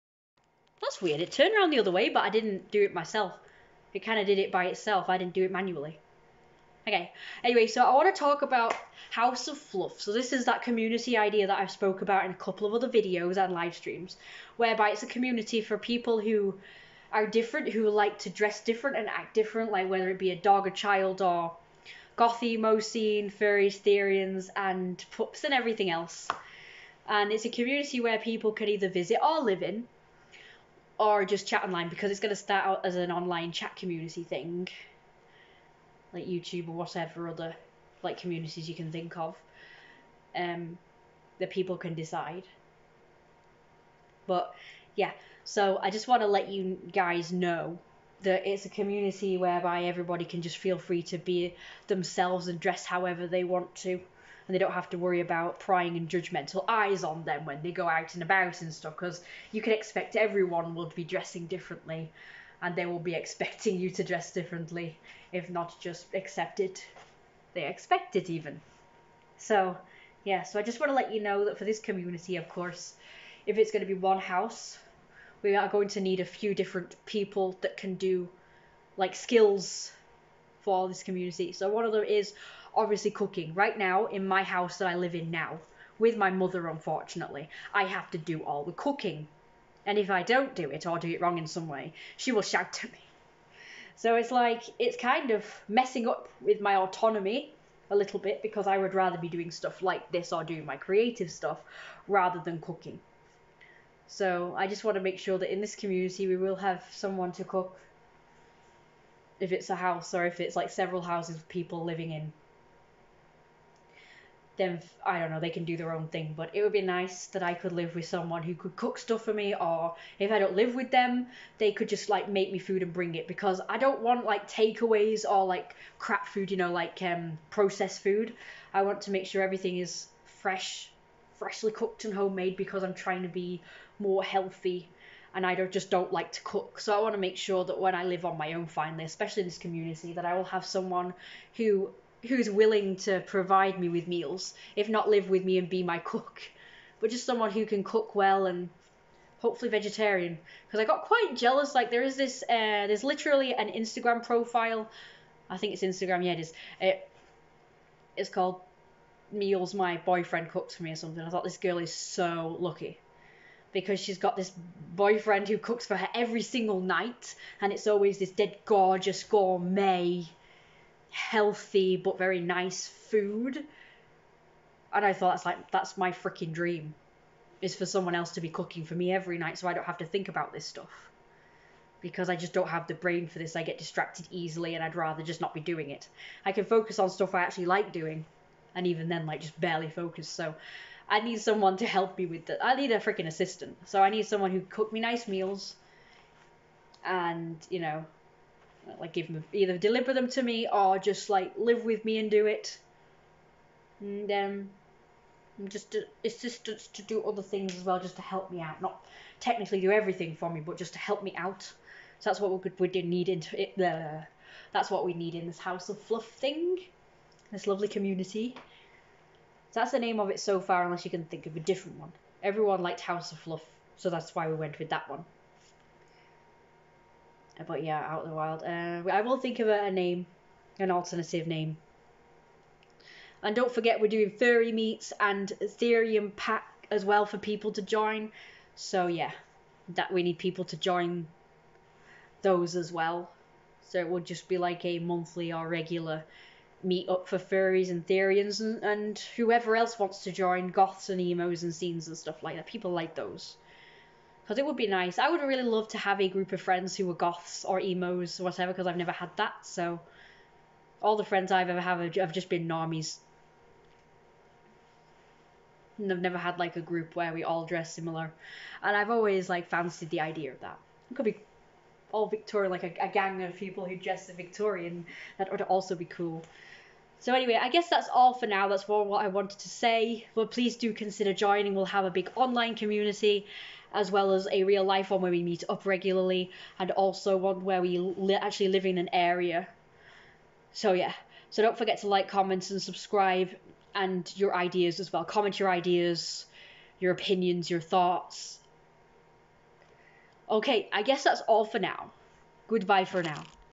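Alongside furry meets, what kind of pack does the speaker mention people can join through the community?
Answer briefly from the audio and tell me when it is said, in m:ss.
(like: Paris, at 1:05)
Therian pack, at 3:55.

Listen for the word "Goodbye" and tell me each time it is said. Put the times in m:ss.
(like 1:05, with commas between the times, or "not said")
5:02.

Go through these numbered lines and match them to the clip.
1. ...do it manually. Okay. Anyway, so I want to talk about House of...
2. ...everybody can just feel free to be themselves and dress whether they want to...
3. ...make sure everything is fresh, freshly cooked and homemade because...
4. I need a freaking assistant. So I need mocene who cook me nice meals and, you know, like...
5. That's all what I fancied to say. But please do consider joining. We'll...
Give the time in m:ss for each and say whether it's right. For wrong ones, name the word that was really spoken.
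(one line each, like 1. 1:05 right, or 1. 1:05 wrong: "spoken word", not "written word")
1. 0:05 right
2. 0:49 wrong: "however", not "whether"
3. 2:09 right
4. 3:12 wrong: "someone", not "mocene"
5. 4:38 wrong: "wanted", not "fancied".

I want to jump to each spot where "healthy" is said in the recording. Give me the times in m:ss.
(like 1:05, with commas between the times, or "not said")
2:14, 2:51.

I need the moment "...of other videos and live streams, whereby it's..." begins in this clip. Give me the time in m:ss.
0:12.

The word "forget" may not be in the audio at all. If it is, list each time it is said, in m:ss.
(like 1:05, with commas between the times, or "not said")
3:53, 4:51.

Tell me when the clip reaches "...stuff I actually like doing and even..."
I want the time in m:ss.
3:07.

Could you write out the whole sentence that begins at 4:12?
People like those because it would be nice.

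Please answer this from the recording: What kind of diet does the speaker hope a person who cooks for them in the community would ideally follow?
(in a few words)
vegetarian.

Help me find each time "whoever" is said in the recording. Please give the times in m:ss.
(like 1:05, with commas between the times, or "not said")
4:09.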